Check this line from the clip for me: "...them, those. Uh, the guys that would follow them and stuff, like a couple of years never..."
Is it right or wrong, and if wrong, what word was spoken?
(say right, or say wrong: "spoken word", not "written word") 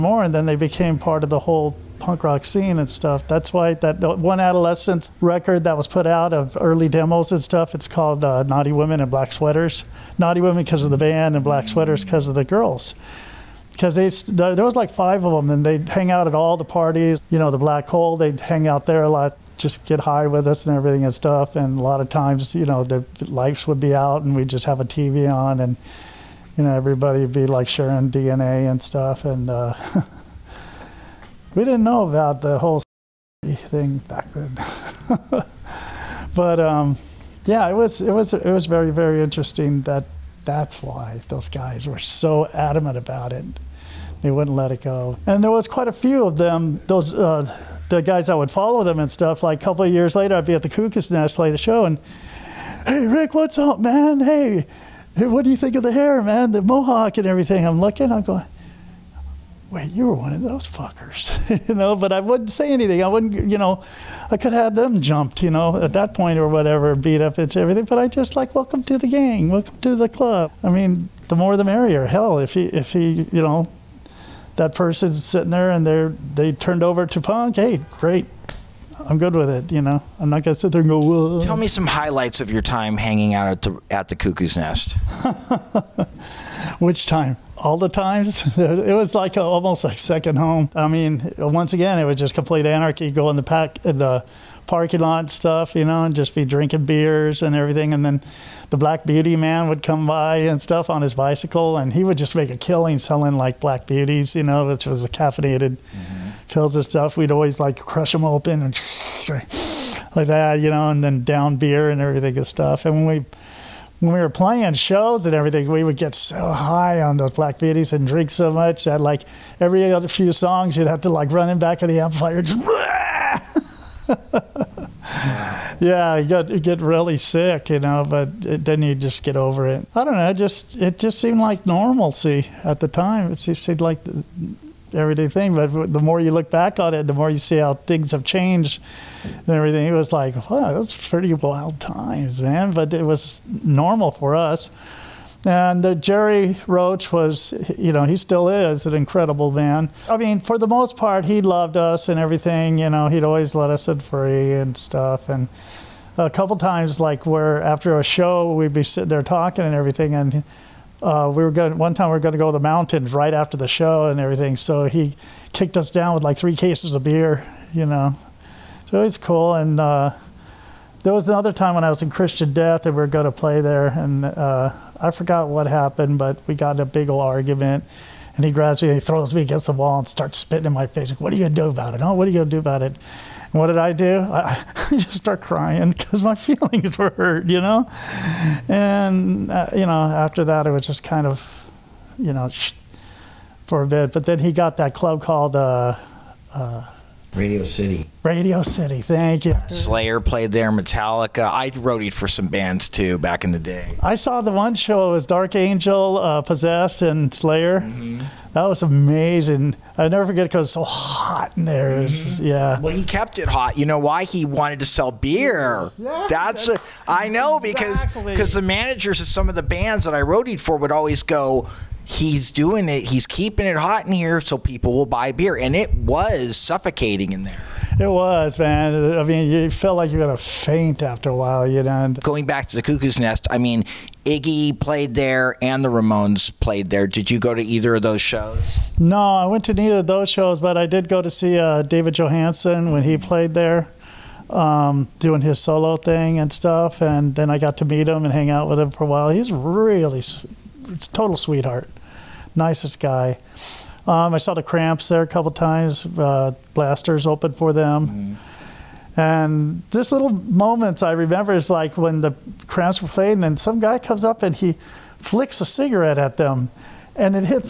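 wrong: "later", not "never".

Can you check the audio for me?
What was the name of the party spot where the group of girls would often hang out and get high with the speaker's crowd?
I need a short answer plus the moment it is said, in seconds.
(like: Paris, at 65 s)
Black Hole, at 17 s.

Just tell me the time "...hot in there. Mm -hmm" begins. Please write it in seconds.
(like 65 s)
210 s.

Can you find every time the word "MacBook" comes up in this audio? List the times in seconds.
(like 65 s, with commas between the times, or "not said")
not said.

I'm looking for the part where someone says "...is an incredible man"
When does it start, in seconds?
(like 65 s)
148 s.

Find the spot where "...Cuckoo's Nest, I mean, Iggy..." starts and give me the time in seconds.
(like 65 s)
232 s.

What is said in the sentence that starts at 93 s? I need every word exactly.
Go in the pack, in the parking lot stuff, you know, and just be drinking beers and everything.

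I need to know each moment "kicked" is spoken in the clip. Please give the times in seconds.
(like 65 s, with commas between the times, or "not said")
165 s.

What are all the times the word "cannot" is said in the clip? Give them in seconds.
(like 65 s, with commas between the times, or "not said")
not said.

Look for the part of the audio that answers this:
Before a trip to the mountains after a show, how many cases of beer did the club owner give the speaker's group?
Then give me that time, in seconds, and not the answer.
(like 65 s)
166 s.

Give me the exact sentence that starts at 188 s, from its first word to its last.
And, uh, you know, after that, it was just kind of, you know, for a bit.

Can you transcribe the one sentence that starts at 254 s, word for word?
Um, I saw the Cramps there a couple times.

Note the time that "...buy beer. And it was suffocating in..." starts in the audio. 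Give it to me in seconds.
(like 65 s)
225 s.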